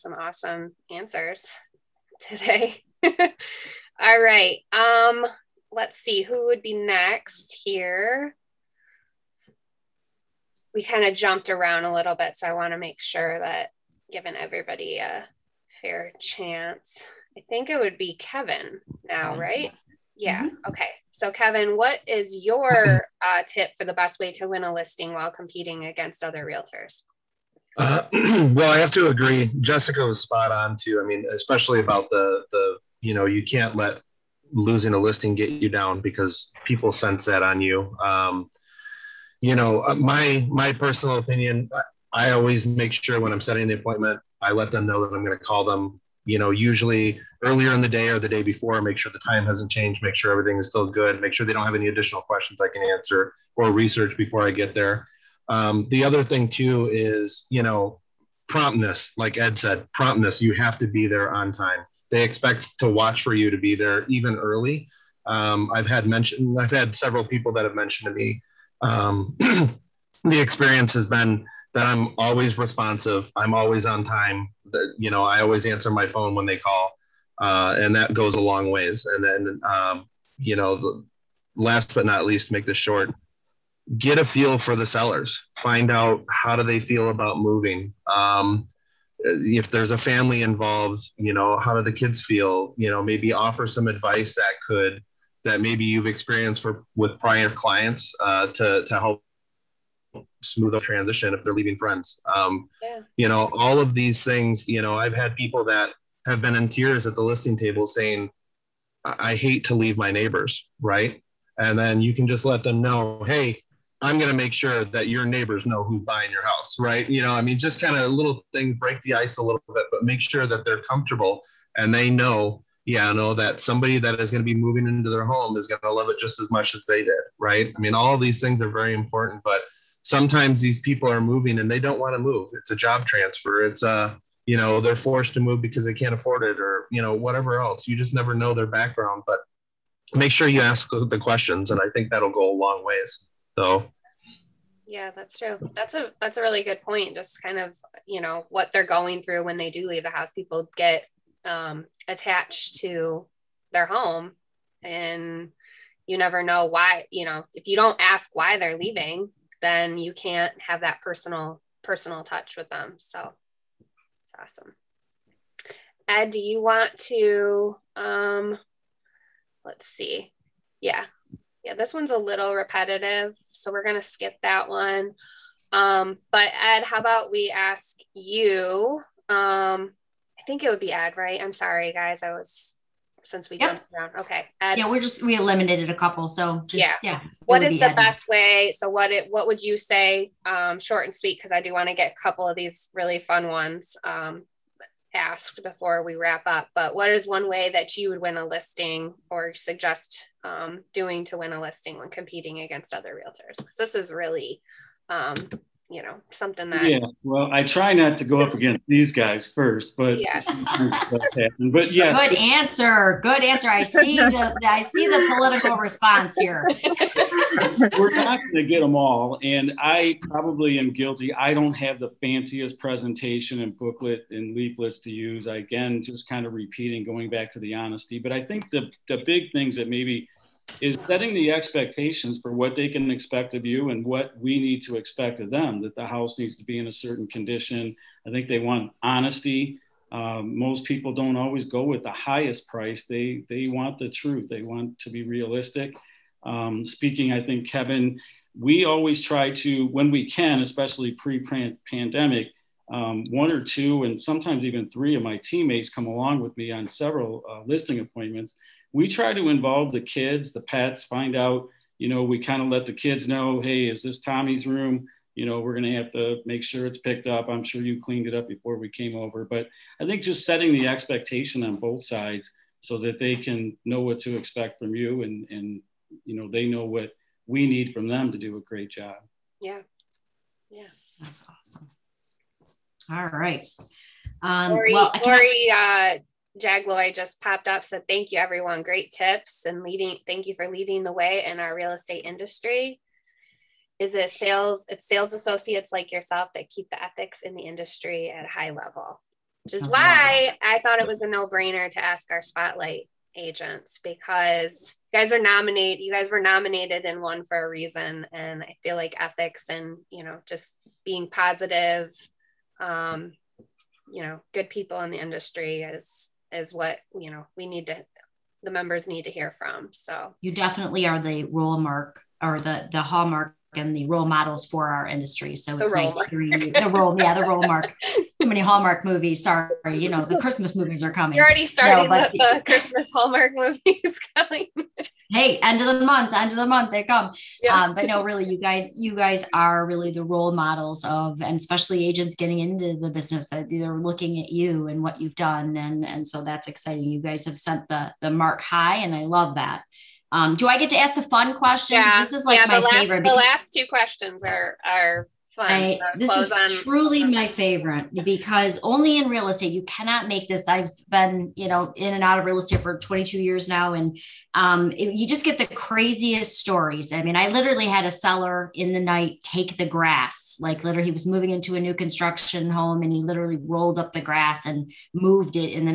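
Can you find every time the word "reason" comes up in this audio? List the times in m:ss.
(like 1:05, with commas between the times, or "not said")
5:07.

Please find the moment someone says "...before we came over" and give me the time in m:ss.
4:28.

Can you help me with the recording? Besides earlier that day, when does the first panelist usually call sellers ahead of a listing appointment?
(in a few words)
the day before.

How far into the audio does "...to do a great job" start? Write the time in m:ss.
4:38.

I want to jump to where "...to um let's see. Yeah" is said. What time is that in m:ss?
2:47.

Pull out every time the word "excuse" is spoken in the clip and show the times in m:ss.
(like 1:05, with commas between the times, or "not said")
not said.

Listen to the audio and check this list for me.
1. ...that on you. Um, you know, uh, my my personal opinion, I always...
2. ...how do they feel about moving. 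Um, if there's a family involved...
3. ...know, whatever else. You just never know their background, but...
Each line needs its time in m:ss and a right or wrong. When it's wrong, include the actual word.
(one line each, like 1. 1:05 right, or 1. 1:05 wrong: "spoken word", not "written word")
1. 0:37 right
2. 1:26 right
3. 2:17 right.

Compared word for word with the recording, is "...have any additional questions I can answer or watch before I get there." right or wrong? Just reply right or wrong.
wrong.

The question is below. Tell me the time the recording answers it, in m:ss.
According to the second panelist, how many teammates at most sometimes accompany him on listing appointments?
4:14.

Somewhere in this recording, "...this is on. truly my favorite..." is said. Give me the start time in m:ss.
5:56.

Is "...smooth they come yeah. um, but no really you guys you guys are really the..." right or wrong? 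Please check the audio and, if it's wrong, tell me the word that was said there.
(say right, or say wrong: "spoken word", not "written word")
wrong: "month", not "smooth".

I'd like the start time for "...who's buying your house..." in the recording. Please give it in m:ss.
1:55.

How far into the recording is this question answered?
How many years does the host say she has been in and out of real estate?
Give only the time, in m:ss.
6:02.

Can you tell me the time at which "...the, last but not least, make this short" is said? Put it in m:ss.
1:20.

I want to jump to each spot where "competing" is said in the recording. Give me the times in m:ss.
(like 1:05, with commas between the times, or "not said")
0:25, 3:22.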